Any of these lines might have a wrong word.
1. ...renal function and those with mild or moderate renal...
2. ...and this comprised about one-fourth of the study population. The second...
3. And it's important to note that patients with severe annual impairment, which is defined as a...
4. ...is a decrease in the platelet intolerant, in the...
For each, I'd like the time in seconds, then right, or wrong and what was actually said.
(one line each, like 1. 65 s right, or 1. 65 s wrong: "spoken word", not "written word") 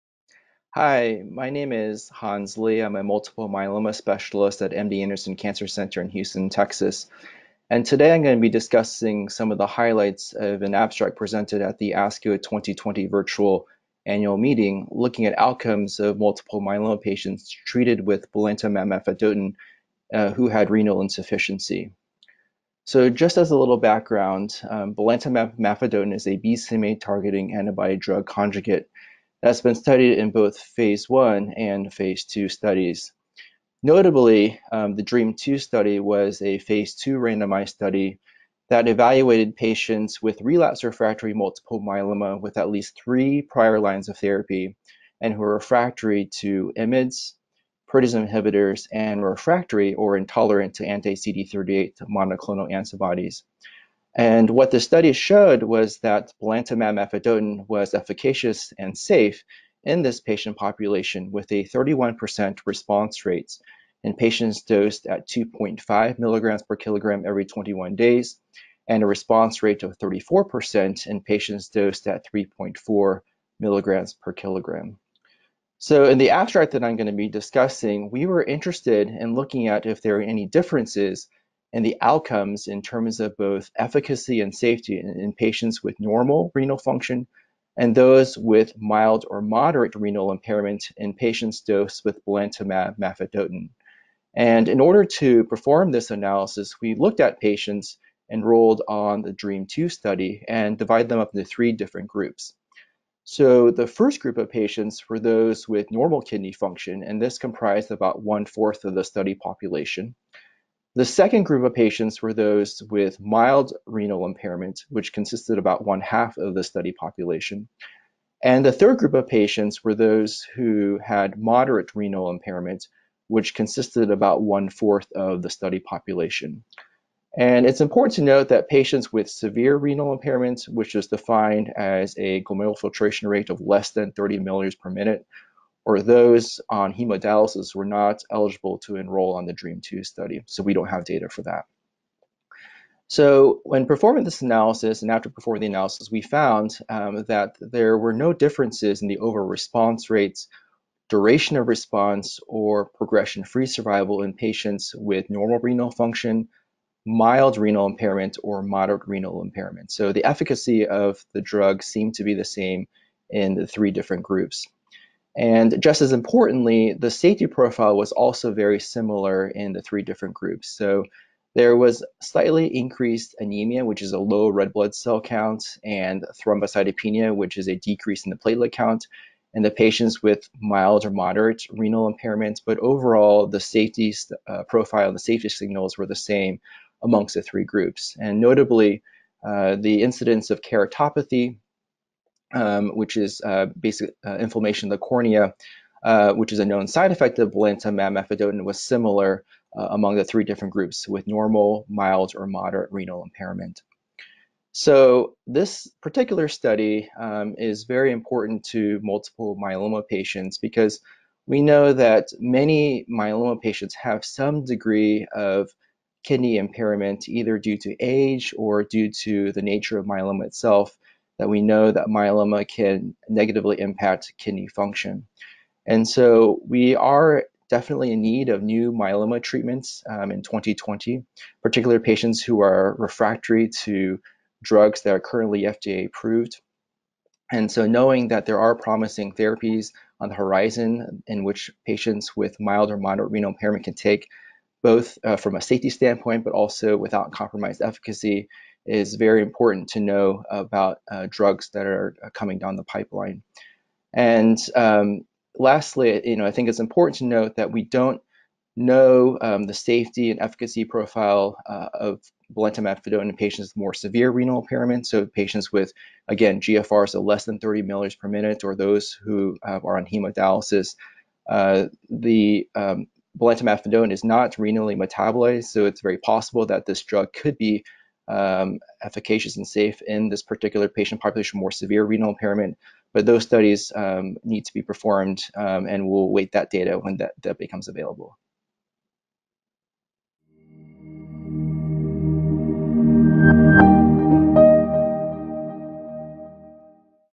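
1. 86 s right
2. 107 s right
3. 127 s wrong: "renal", not "annual"
4. 177 s wrong: "count", not "intolerant".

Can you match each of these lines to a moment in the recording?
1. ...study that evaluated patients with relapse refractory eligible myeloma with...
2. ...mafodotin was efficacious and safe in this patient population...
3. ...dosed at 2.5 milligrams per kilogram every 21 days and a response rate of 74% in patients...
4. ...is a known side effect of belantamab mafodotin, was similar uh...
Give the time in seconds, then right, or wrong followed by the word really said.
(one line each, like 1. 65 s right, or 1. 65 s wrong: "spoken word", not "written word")
1. 37 s wrong: "multiple", not "eligible"
2. 56 s right
3. 64 s wrong: "34", not "74"
4. 196 s right.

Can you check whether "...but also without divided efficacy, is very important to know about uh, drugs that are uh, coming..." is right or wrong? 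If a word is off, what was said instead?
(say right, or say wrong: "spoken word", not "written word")
wrong: "compromised", not "divided".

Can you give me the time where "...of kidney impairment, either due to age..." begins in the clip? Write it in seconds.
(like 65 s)
215 s.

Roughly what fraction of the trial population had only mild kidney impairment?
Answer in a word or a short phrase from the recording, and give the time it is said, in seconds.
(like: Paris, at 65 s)
one half, at 115 s.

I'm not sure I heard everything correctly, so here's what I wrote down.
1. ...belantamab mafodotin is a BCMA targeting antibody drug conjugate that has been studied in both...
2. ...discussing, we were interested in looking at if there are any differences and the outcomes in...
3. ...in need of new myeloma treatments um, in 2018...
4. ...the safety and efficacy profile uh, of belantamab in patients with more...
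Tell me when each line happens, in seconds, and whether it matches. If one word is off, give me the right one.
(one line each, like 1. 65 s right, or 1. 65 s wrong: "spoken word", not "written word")
1. 24 s right
2. 77 s right
3. 228 s wrong: "2020", not "2018"
4. 259 s right.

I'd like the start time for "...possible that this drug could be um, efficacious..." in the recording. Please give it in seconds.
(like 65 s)
276 s.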